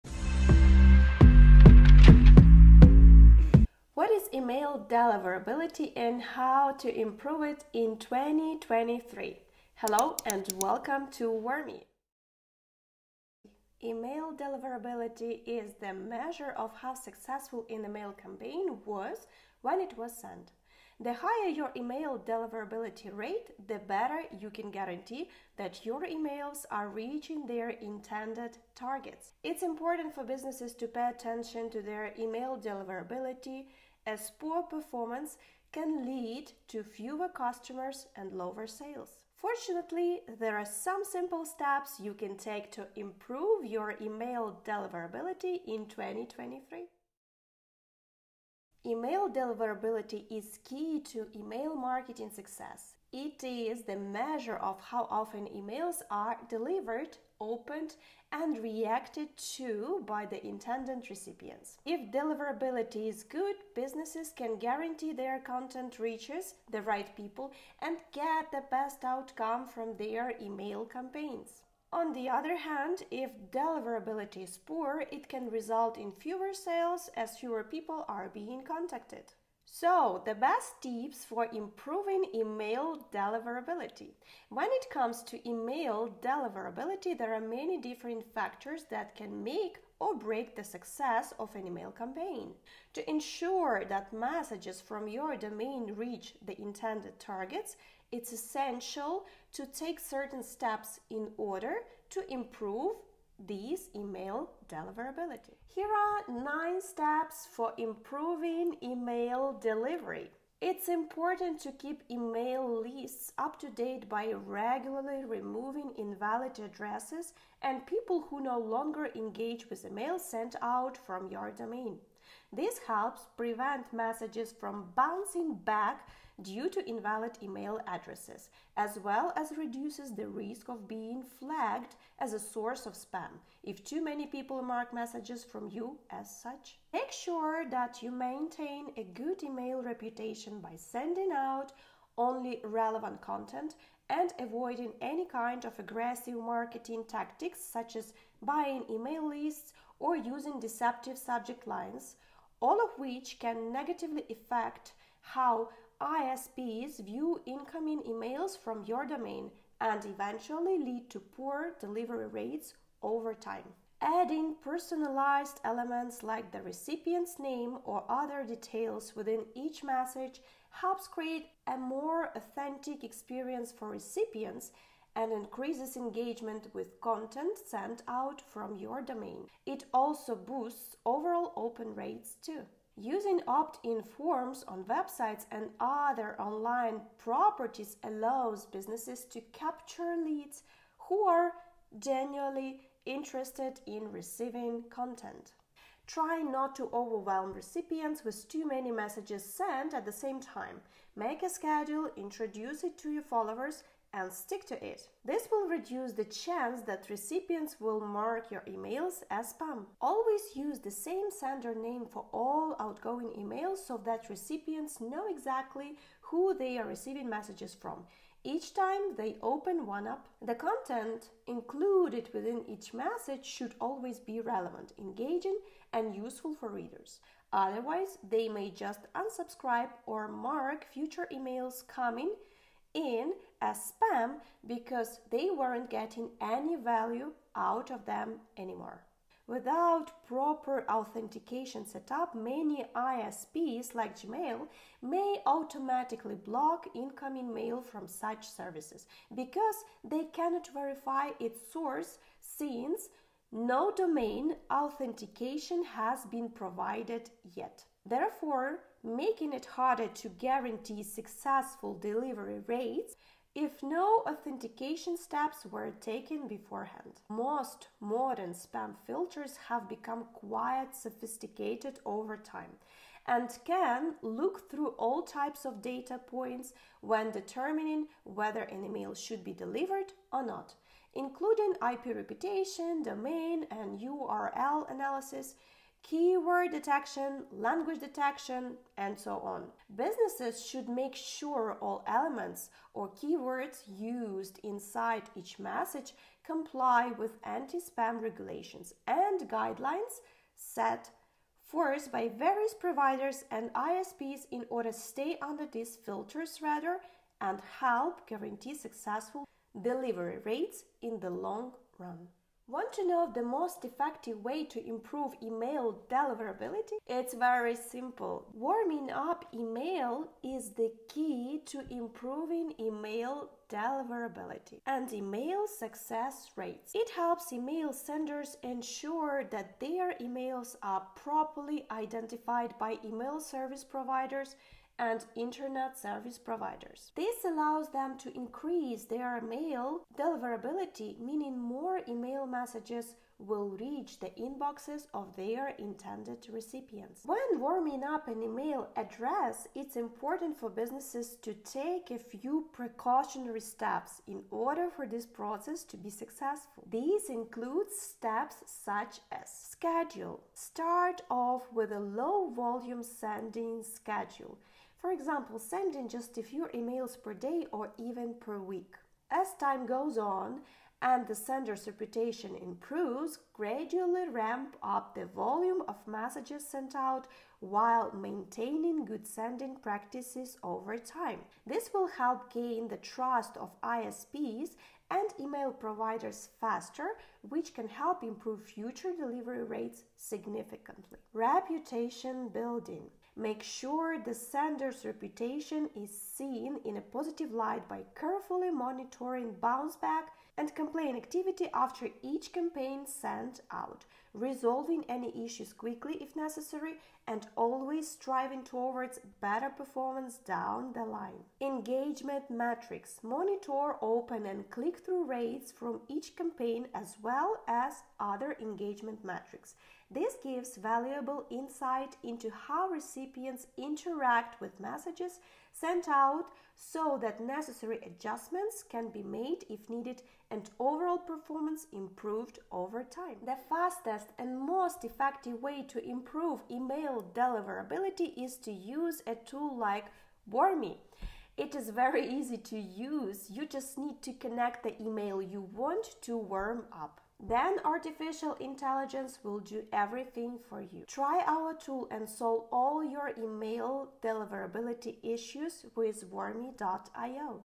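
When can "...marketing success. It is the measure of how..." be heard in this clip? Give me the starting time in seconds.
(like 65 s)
51 s.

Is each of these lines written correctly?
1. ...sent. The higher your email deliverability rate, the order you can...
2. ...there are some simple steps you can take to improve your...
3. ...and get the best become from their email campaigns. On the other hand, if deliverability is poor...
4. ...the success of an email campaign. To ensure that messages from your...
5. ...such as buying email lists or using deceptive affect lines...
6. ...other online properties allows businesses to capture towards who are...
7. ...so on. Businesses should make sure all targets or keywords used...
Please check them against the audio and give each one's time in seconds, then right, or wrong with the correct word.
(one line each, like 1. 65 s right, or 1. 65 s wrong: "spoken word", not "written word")
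1. 20 s wrong: "better", not "order"
2. 40 s right
3. 67 s wrong: "outcome", not "become"
4. 90 s right
5. 147 s wrong: "subject", not "affect"
6. 185 s wrong: "leads", not "towards"
7. 289 s wrong: "elements", not "targets".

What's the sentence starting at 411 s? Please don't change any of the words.
Engagement metrics monitor open and click through rates from each campaign as well as other engagement metrics.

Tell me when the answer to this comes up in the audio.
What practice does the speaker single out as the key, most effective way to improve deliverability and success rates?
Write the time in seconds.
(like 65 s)
318 s.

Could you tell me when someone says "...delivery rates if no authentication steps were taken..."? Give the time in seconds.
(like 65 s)
261 s.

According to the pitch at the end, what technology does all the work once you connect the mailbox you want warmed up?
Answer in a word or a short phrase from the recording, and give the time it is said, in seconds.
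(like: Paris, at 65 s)
artificial intelligence, at 447 s.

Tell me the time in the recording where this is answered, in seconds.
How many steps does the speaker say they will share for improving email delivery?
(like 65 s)
106 s.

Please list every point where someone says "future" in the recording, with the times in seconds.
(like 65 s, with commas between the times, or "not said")
230 s, 388 s.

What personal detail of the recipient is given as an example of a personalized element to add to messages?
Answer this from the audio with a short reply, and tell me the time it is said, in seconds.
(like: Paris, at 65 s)
recipient's name, at 166 s.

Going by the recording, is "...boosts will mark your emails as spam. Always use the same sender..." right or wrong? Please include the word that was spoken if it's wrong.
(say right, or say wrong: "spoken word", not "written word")
wrong: "recipients", not "boosts".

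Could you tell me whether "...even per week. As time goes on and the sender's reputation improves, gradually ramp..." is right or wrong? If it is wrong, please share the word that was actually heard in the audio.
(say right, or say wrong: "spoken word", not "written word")
right.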